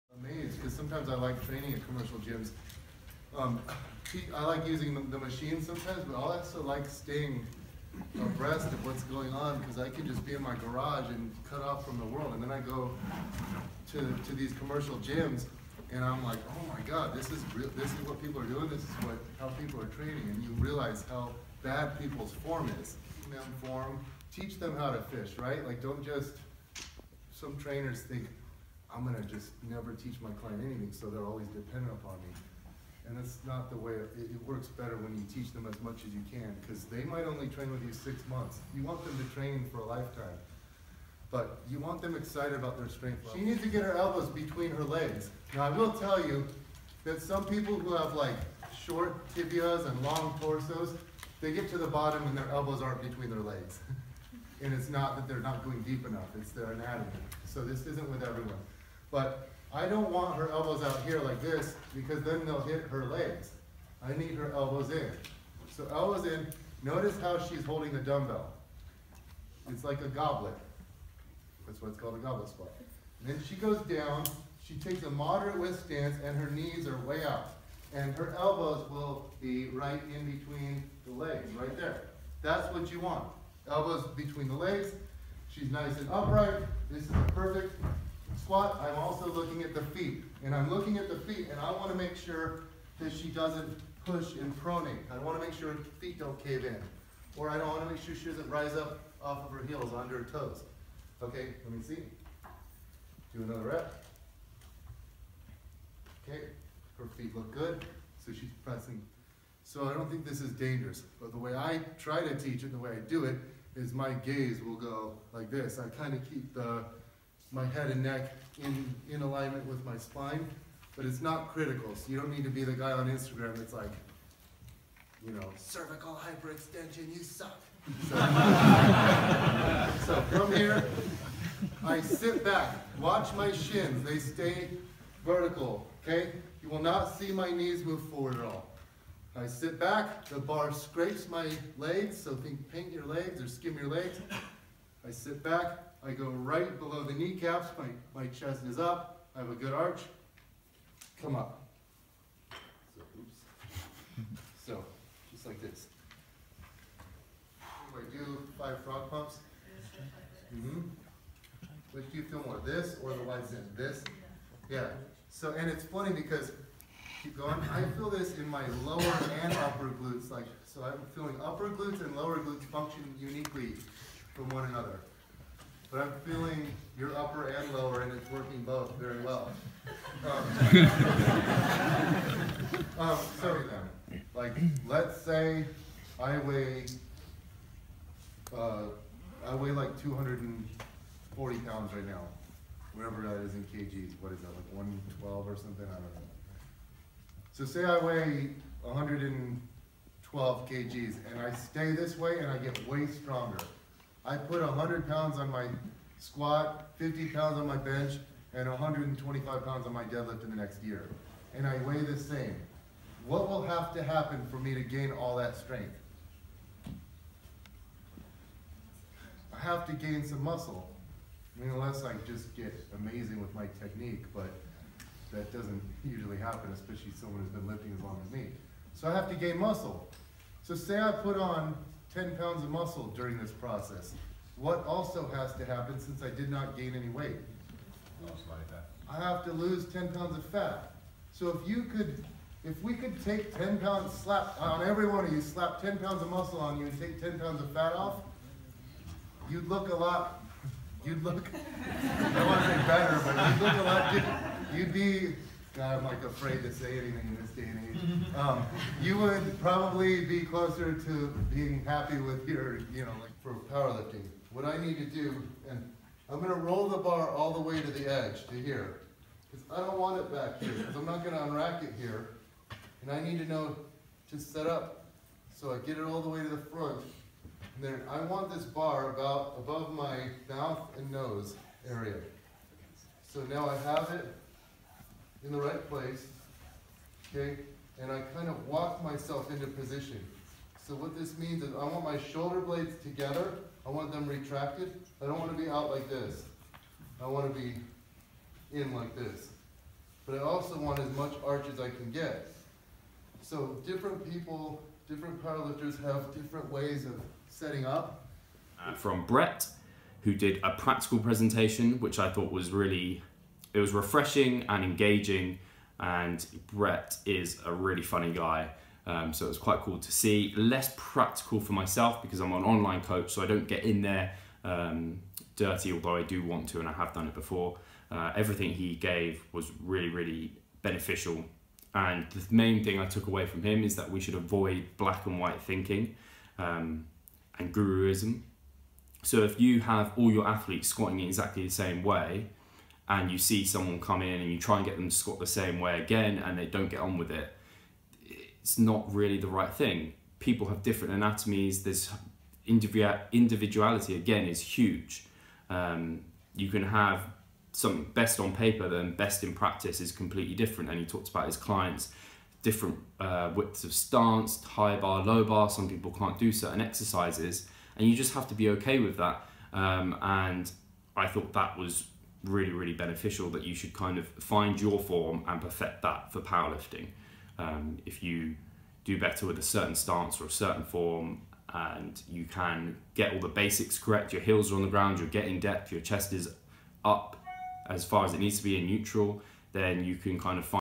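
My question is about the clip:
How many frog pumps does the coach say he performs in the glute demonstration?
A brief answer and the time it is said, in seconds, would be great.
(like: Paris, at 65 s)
5, at 158 s.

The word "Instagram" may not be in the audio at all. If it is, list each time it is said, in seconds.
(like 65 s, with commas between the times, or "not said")
123 s.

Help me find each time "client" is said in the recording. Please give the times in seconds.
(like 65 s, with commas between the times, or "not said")
30 s, 361 s.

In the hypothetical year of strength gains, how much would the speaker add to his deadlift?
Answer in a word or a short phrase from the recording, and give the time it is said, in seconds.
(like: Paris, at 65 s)
125 pounds, at 208 s.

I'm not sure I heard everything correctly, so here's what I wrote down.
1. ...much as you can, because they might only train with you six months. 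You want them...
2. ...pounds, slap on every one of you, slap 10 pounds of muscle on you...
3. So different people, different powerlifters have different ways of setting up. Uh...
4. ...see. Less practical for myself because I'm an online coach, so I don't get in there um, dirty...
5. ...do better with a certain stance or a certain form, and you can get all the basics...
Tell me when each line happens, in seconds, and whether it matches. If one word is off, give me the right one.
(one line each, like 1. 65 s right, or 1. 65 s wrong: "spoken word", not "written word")
1. 35 s right
2. 243 s right
3. 303 s right
4. 320 s right
5. 379 s right.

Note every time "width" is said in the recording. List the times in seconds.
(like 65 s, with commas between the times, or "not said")
75 s, 363 s.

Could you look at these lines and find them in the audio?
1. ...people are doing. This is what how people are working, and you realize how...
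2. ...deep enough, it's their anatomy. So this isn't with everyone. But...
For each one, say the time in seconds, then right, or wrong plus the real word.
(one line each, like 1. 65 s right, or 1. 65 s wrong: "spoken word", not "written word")
1. 18 s wrong: "training", not "working"
2. 55 s right.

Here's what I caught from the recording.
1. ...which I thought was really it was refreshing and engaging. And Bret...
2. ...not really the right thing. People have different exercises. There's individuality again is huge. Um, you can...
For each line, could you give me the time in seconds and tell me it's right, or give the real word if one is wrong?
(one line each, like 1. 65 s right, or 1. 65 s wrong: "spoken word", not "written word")
1. 311 s right
2. 348 s wrong: "anatomies", not "exercises".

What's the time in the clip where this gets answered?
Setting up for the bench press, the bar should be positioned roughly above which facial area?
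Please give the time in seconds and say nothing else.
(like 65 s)
280 s.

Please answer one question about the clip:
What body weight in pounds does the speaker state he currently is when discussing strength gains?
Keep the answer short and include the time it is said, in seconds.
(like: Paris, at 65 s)
240 pounds, at 190 s.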